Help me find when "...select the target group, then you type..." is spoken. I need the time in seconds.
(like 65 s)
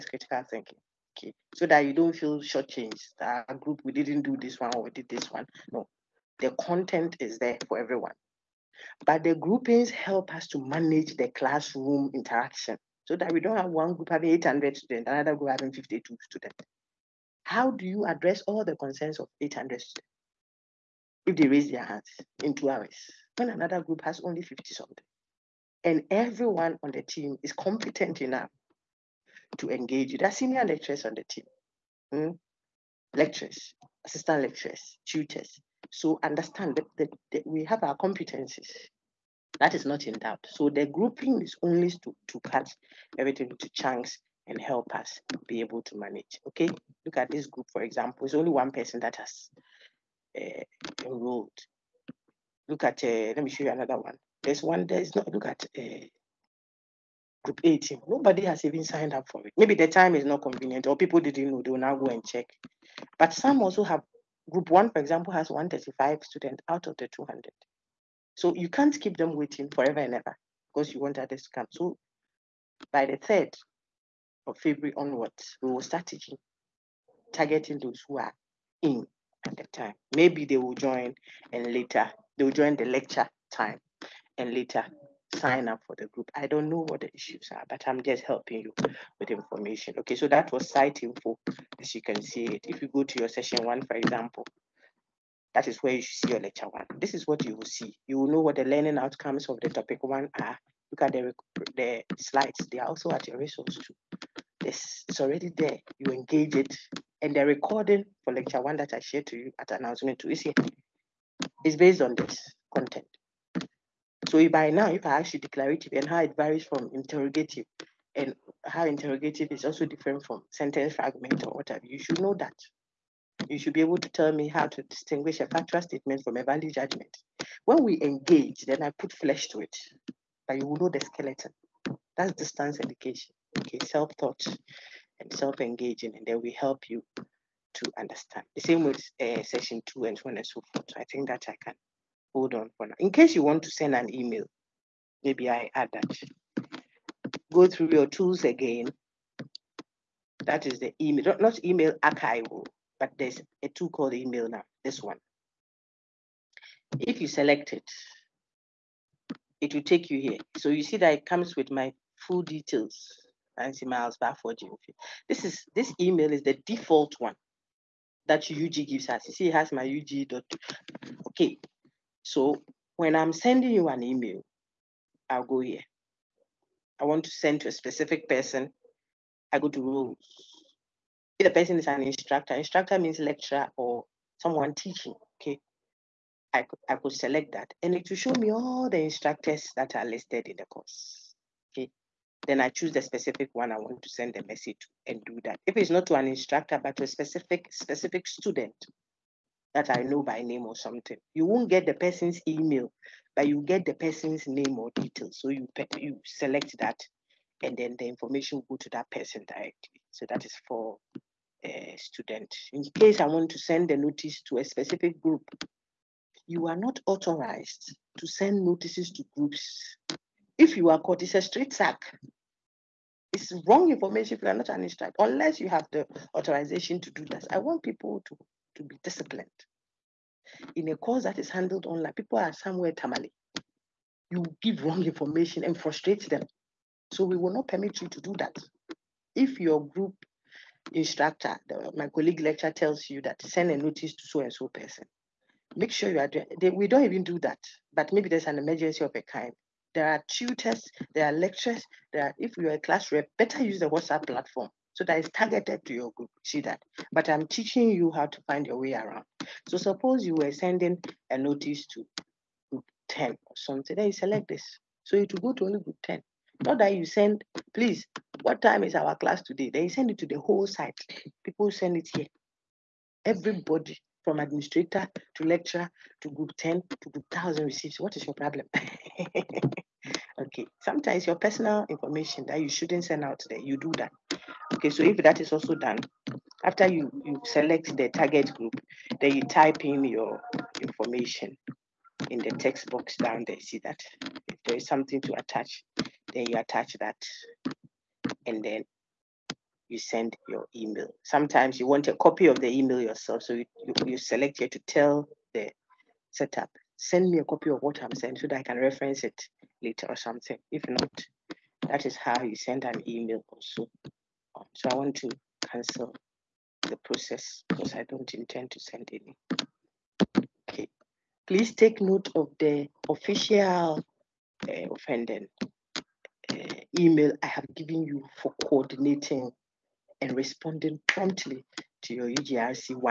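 287 s.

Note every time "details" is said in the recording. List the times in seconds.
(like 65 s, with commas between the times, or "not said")
162 s, 204 s.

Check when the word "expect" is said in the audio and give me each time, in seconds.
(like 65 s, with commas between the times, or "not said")
not said.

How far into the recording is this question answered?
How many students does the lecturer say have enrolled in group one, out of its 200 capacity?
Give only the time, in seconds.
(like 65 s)
65 s.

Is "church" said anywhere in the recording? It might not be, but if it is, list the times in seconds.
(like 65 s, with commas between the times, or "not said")
not said.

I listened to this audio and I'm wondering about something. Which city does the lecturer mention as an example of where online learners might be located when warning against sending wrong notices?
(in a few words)
Tamale.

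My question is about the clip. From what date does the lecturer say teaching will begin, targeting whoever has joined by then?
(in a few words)
3rd of February.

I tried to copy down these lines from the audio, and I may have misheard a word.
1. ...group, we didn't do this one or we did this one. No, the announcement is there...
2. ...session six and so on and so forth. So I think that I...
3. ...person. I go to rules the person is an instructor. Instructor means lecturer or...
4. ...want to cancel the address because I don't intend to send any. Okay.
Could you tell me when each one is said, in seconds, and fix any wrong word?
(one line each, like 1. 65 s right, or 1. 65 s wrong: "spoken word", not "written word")
1. 3 s wrong: "content", not "announcement"
2. 139 s wrong: "two", not "six"
3. 178 s right
4. 314 s wrong: "process", not "address".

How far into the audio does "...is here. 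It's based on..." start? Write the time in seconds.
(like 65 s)
110 s.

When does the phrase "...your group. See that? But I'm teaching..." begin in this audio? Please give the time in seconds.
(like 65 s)
255 s.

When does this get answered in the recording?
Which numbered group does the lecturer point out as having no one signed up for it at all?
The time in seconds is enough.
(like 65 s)
57 s.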